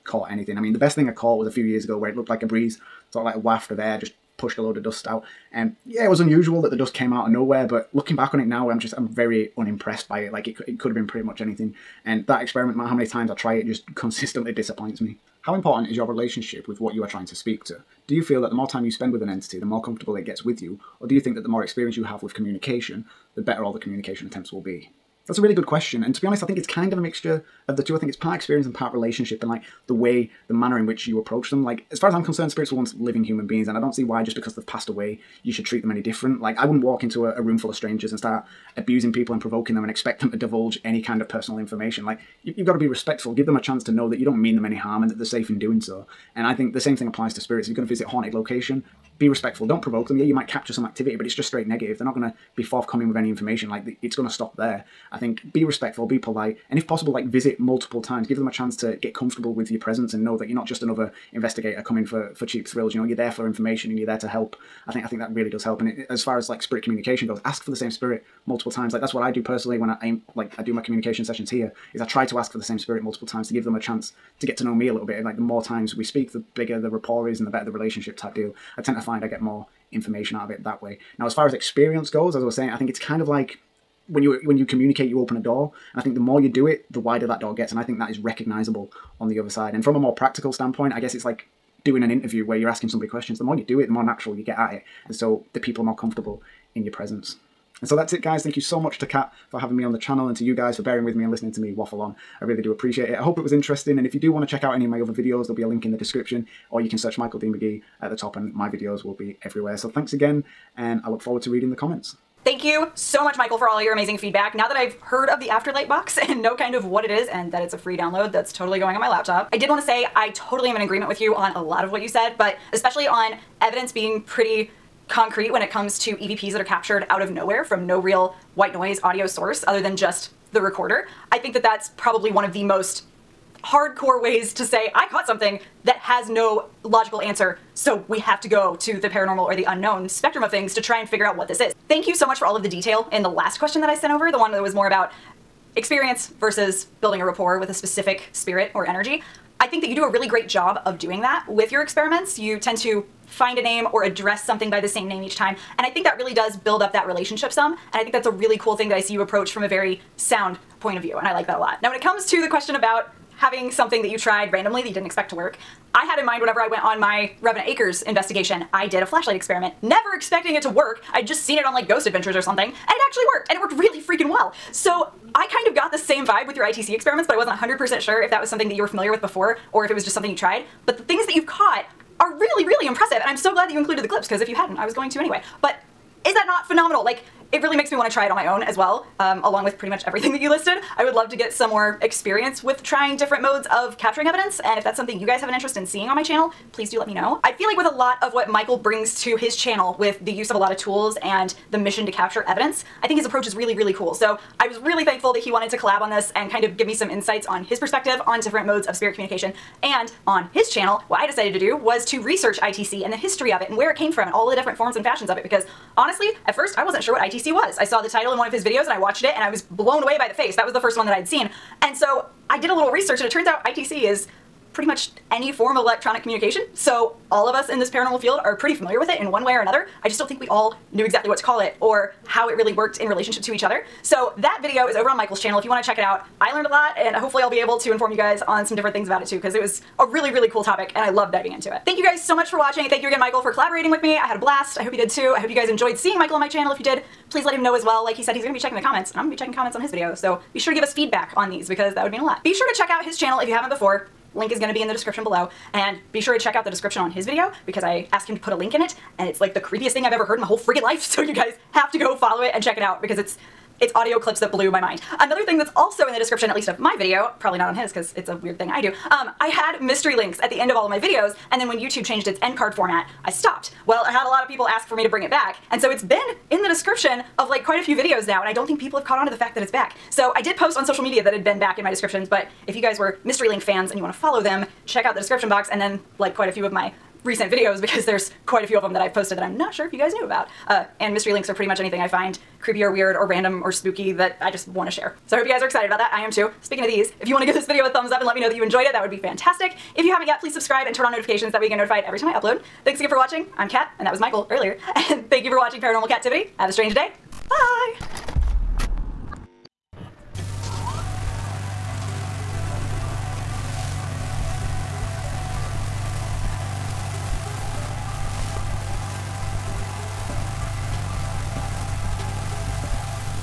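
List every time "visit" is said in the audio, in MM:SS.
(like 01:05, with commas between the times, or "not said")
00:47, 00:57.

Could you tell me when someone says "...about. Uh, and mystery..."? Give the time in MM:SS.
04:50.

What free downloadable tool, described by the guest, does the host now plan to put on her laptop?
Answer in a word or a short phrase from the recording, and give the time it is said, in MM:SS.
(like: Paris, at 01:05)
Afterlight box, at 01:55.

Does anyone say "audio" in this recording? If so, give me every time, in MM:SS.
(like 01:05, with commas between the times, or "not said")
02:09, 04:23.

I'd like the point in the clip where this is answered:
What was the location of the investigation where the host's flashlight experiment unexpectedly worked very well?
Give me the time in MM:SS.
02:47.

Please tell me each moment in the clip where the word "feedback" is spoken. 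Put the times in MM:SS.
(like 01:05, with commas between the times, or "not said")
01:54, 04:10.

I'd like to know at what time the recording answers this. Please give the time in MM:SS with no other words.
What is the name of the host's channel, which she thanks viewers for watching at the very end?
05:05.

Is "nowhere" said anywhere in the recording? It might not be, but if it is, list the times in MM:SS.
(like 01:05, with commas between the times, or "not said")
00:07, 02:07.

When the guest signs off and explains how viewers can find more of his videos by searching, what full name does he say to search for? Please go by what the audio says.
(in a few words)
Michael Dean MaGee.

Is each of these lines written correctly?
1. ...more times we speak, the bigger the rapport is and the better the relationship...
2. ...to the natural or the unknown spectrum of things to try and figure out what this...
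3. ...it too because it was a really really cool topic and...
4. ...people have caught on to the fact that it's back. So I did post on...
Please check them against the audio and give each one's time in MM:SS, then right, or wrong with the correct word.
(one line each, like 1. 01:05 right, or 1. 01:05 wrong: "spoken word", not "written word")
1. 01:15 right
2. 02:18 wrong: "paranormal", not "natural"
3. 03:59 right
4. 04:38 right.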